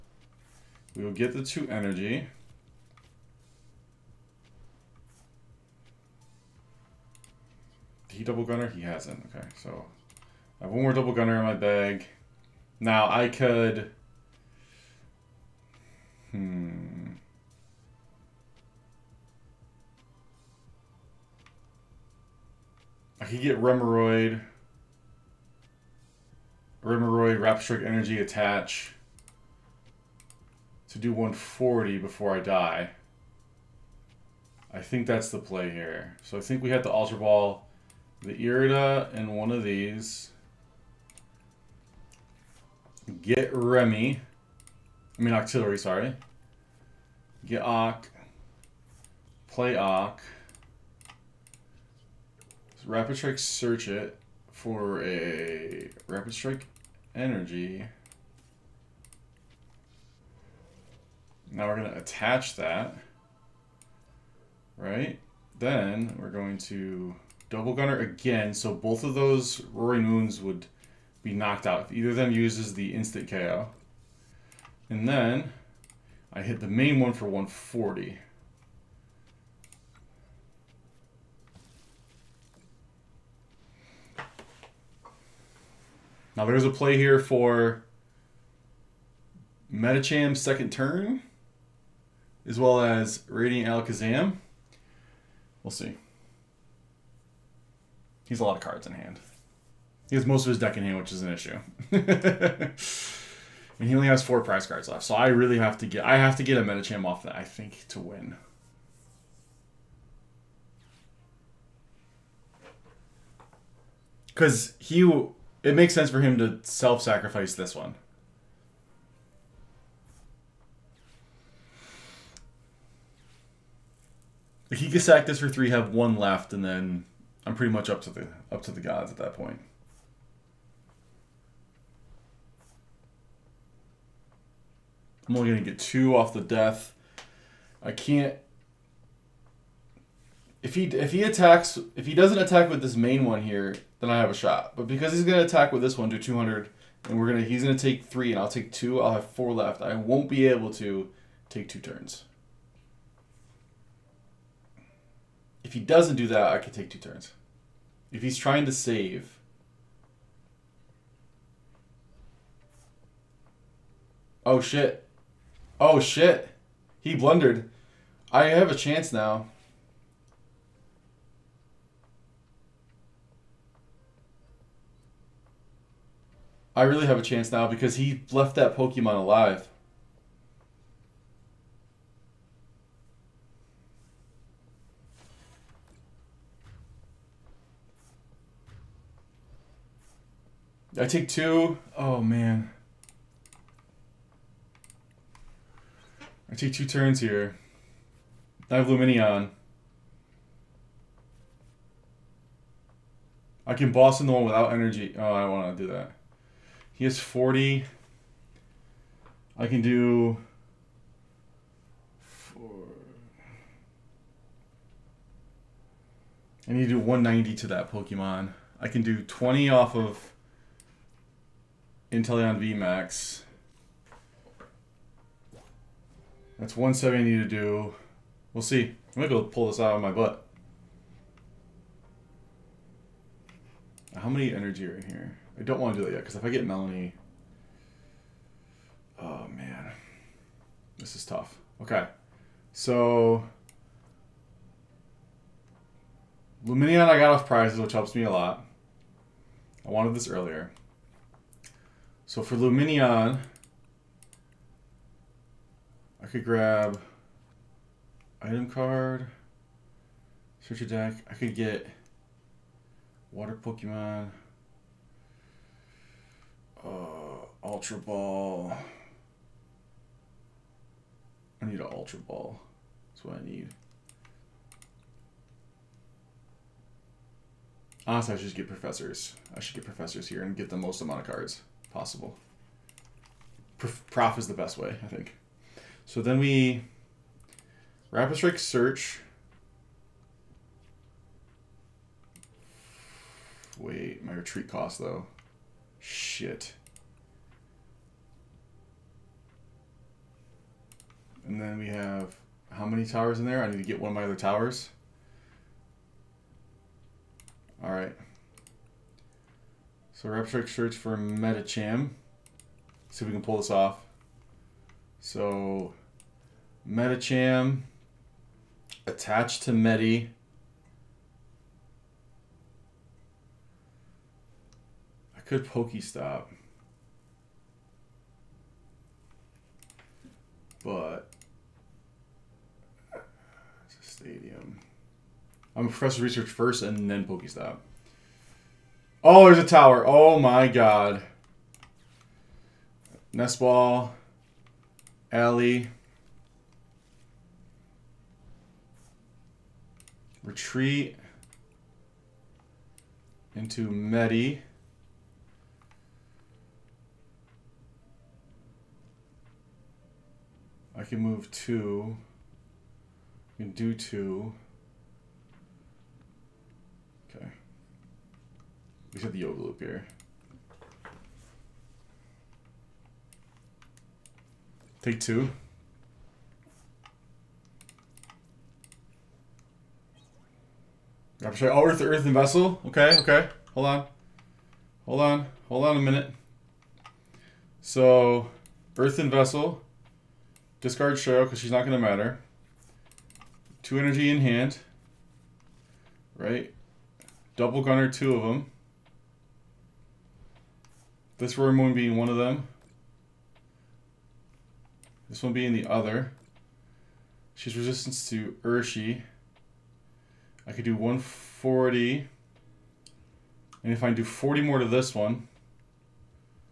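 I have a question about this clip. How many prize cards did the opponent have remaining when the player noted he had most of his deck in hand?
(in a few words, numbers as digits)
4.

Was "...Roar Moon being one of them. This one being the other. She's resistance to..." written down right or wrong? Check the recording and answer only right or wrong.
right.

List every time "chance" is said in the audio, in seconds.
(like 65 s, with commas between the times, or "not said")
168 s, 177 s.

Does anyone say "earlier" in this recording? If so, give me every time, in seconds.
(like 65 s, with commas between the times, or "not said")
250 s.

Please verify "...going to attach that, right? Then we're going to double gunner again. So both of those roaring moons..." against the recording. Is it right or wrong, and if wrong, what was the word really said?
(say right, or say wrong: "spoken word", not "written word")
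right.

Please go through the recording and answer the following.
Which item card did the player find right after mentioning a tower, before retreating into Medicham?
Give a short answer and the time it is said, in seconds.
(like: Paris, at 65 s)
Nest Ball, at 343 s.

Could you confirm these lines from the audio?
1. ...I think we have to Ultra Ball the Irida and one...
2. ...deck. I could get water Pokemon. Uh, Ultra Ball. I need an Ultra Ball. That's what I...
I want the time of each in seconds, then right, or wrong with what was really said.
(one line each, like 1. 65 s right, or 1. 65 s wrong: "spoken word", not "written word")
1. 36 s right
2. 260 s right.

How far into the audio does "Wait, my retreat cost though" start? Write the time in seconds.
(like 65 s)
293 s.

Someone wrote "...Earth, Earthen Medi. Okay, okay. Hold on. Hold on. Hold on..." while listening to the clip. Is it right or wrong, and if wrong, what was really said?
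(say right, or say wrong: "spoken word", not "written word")
wrong: "Vessel", not "Medi".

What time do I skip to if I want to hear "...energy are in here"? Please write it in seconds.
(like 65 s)
234 s.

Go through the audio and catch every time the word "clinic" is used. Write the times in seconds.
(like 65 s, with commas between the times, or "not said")
not said.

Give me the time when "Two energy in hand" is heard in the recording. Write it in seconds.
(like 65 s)
393 s.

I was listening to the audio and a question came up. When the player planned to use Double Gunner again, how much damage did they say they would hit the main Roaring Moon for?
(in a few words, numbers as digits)
140.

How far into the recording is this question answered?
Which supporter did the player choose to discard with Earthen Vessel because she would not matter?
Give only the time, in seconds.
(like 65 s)
390 s.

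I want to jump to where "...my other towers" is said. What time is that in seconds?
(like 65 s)
304 s.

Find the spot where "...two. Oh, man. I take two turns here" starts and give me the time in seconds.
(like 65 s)
191 s.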